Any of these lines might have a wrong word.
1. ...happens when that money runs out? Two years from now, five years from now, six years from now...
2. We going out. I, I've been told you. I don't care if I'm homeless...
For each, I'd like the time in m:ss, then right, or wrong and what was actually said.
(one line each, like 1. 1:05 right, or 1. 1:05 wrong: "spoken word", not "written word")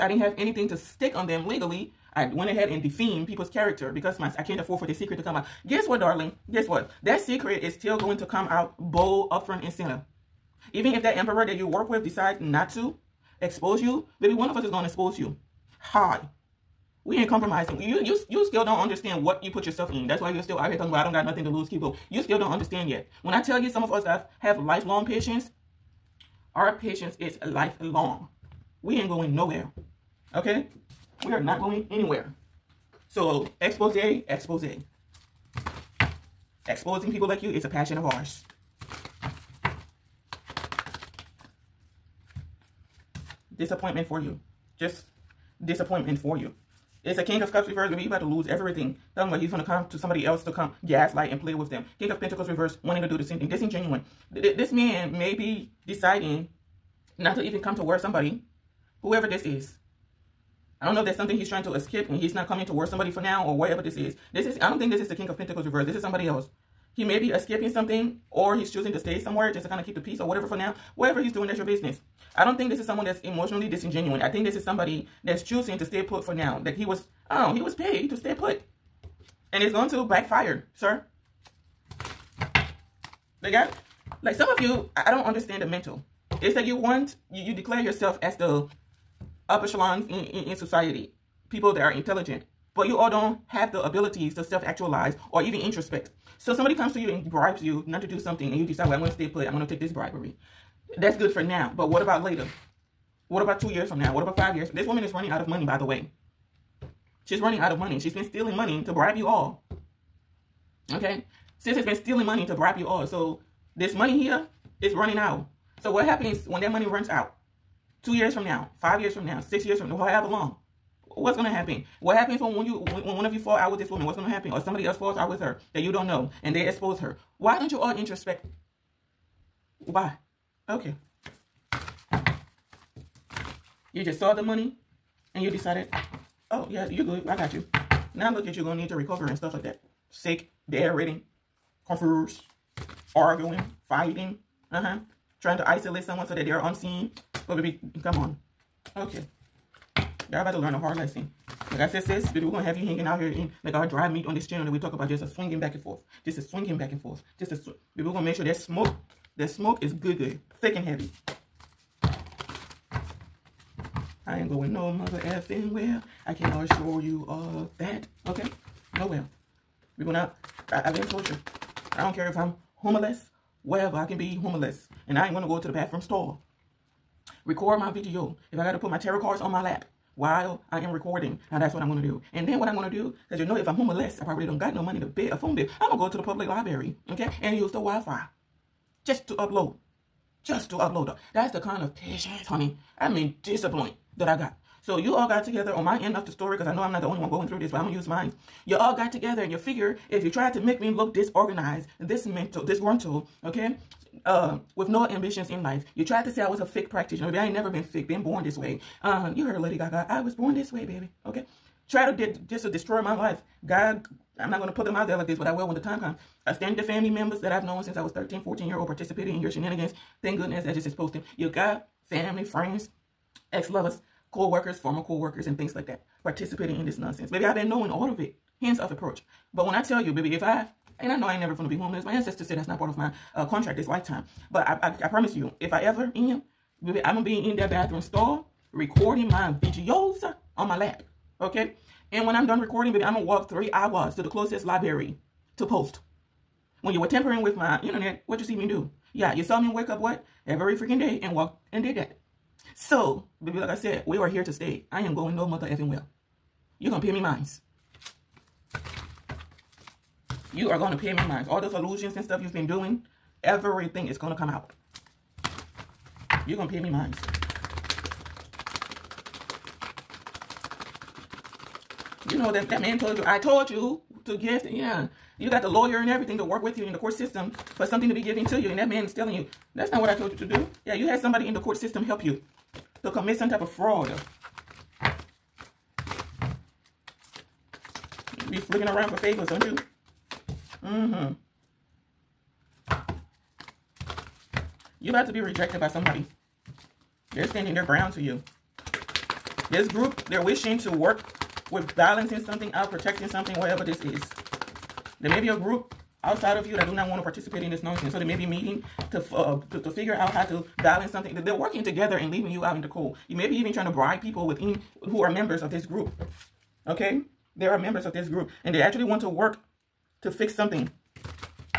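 1. 1:56 right
2. 2:49 right.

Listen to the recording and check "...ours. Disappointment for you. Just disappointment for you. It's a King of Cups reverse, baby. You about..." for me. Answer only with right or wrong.
right.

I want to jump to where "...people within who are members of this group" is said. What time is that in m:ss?
5:14.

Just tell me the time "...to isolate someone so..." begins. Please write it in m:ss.
2:25.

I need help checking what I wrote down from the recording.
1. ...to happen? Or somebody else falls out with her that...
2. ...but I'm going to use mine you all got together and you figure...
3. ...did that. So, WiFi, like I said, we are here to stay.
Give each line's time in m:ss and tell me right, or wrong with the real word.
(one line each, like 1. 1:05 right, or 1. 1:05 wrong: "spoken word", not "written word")
1. 2:04 right
2. 3:17 right
3. 4:11 wrong: "Baby", not "WiFi".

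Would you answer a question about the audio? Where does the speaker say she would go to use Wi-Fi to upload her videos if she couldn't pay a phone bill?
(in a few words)
the public library.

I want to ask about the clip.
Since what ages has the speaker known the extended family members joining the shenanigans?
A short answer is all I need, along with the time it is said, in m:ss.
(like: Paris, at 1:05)
13, 14, at 3:38.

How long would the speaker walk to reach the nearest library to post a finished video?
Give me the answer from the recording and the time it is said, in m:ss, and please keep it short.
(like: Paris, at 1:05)
3 hours, at 4:03.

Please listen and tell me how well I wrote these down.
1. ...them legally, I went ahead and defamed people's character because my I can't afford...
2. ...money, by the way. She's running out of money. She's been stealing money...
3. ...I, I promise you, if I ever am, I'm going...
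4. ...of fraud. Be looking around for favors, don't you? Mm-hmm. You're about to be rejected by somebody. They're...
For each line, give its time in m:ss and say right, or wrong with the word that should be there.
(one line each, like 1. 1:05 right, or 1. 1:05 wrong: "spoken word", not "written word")
1. 0:01 right
2. 1:45 right
3. 3:54 right
4. 4:43 right.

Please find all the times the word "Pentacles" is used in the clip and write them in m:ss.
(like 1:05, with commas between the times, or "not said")
0:52, 1:05.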